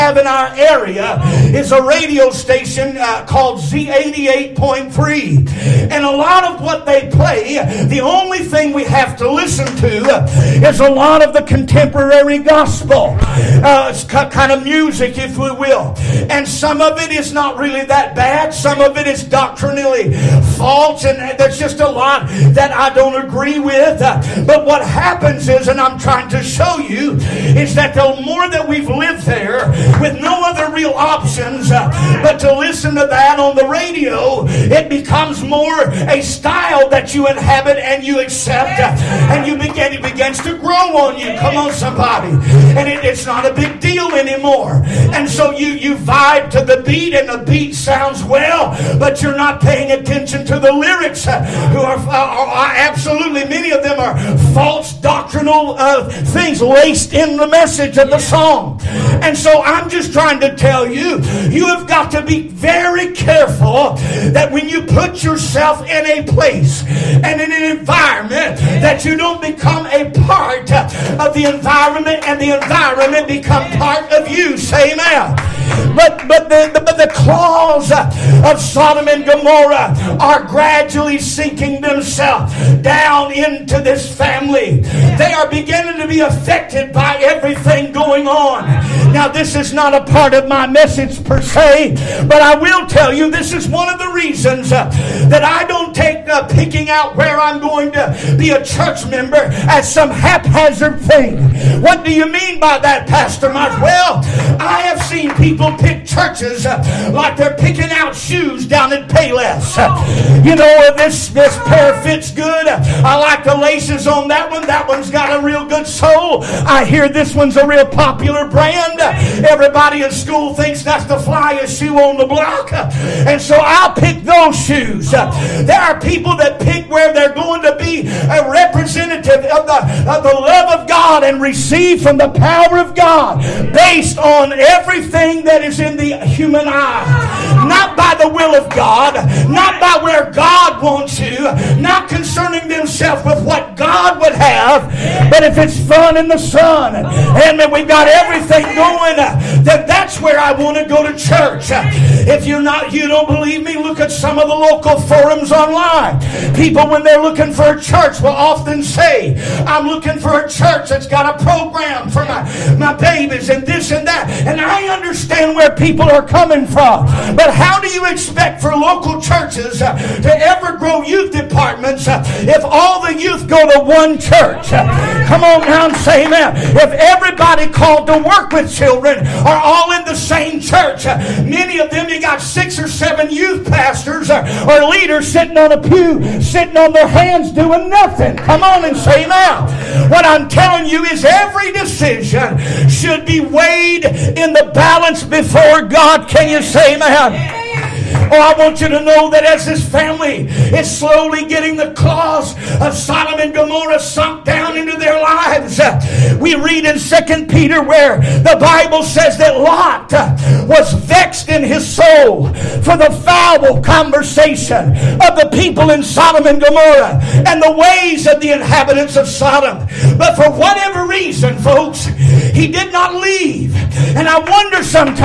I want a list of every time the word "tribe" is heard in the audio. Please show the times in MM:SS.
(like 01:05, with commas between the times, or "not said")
not said.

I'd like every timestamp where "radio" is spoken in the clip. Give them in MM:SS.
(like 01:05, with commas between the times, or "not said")
00:01, 00:33.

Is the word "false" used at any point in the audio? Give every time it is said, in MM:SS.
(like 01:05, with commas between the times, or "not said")
00:20, 00:54.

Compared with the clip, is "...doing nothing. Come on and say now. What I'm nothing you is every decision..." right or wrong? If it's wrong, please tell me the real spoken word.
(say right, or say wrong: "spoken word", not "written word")
wrong: "telling", not "nothing".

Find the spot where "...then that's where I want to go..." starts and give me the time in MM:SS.
02:29.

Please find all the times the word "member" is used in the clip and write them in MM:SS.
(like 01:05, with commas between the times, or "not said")
01:39.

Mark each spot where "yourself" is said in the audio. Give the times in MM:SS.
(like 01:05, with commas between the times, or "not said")
01:05.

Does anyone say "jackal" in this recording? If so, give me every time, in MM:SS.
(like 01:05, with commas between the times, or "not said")
not said.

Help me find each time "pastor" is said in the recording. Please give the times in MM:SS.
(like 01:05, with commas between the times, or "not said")
01:43, 03:03.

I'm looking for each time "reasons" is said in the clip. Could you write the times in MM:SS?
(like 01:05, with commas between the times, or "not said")
01:34, 03:41.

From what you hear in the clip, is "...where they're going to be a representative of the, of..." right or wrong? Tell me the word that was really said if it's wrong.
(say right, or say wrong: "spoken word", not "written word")
right.